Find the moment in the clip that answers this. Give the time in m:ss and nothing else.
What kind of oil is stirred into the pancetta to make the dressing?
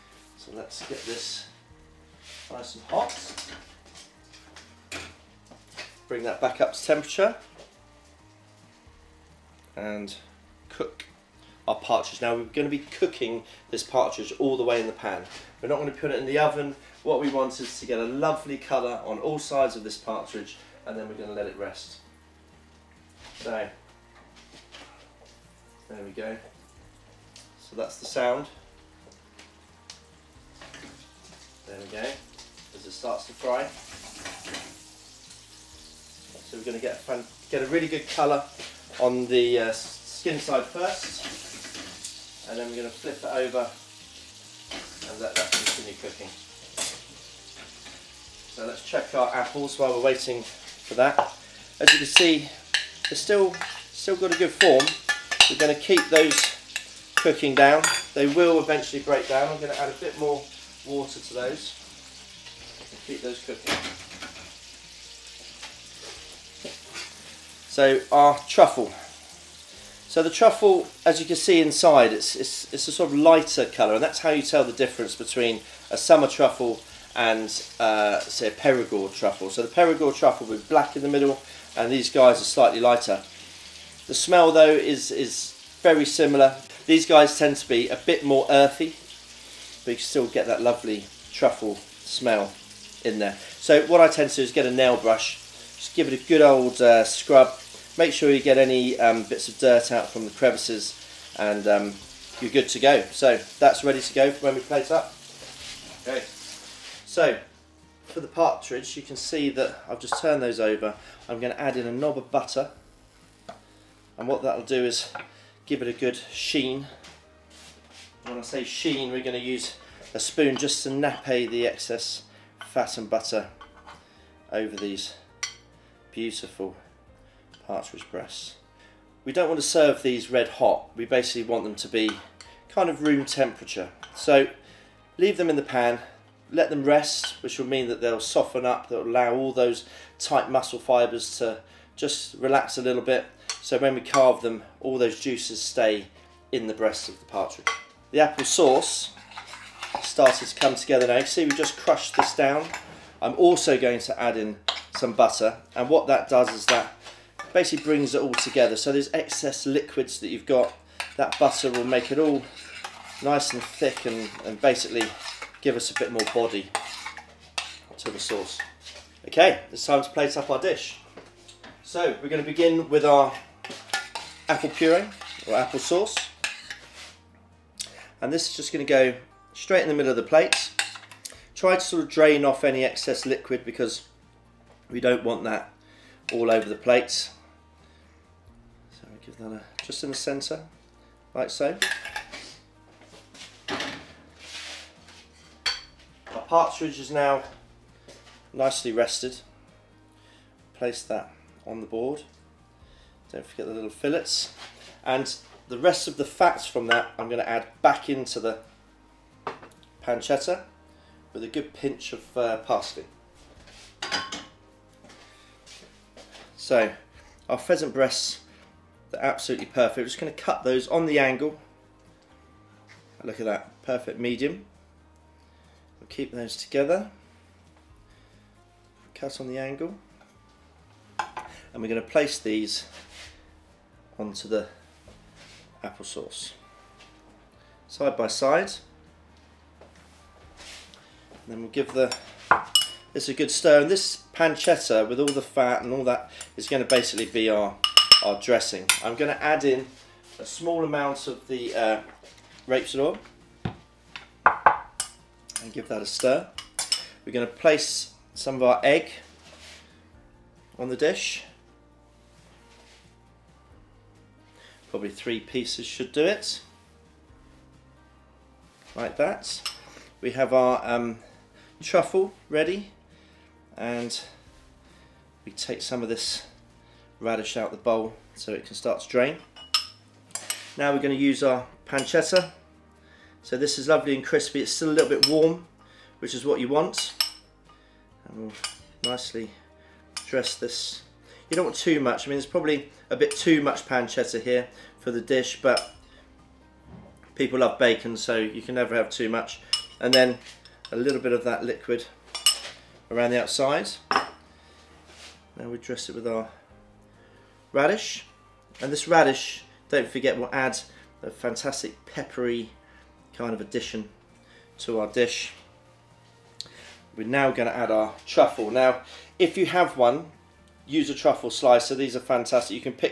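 4:12.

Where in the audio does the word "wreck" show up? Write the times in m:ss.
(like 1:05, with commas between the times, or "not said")
not said.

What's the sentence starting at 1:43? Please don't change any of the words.
So that's ready to go when we plate up.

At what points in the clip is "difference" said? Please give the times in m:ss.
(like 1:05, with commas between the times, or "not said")
1:14.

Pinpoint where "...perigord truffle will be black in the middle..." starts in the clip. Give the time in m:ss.
1:19.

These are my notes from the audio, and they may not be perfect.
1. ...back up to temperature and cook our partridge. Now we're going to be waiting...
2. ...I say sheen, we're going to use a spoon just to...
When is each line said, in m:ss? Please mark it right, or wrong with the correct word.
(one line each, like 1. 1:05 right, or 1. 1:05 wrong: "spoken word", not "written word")
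1. 0:06 wrong: "cooking", not "waiting"
2. 1:58 right.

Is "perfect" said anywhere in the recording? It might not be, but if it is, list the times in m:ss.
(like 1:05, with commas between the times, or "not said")
3:39, 3:43.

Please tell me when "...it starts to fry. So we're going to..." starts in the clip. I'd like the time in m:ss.
0:32.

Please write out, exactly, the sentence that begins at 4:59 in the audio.
And then a little bit of that liquid around the outside.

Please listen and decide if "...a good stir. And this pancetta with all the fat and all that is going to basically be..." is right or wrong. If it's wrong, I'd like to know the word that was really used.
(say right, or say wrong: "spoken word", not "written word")
right.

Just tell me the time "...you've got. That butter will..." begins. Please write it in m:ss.
2:40.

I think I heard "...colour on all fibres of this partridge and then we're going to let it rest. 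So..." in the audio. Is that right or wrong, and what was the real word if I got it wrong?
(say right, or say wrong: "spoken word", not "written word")
wrong: "sides", not "fibres".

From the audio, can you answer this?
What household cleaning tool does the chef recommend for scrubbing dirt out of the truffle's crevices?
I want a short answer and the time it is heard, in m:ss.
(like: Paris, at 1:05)
Nail brush, at 1:34.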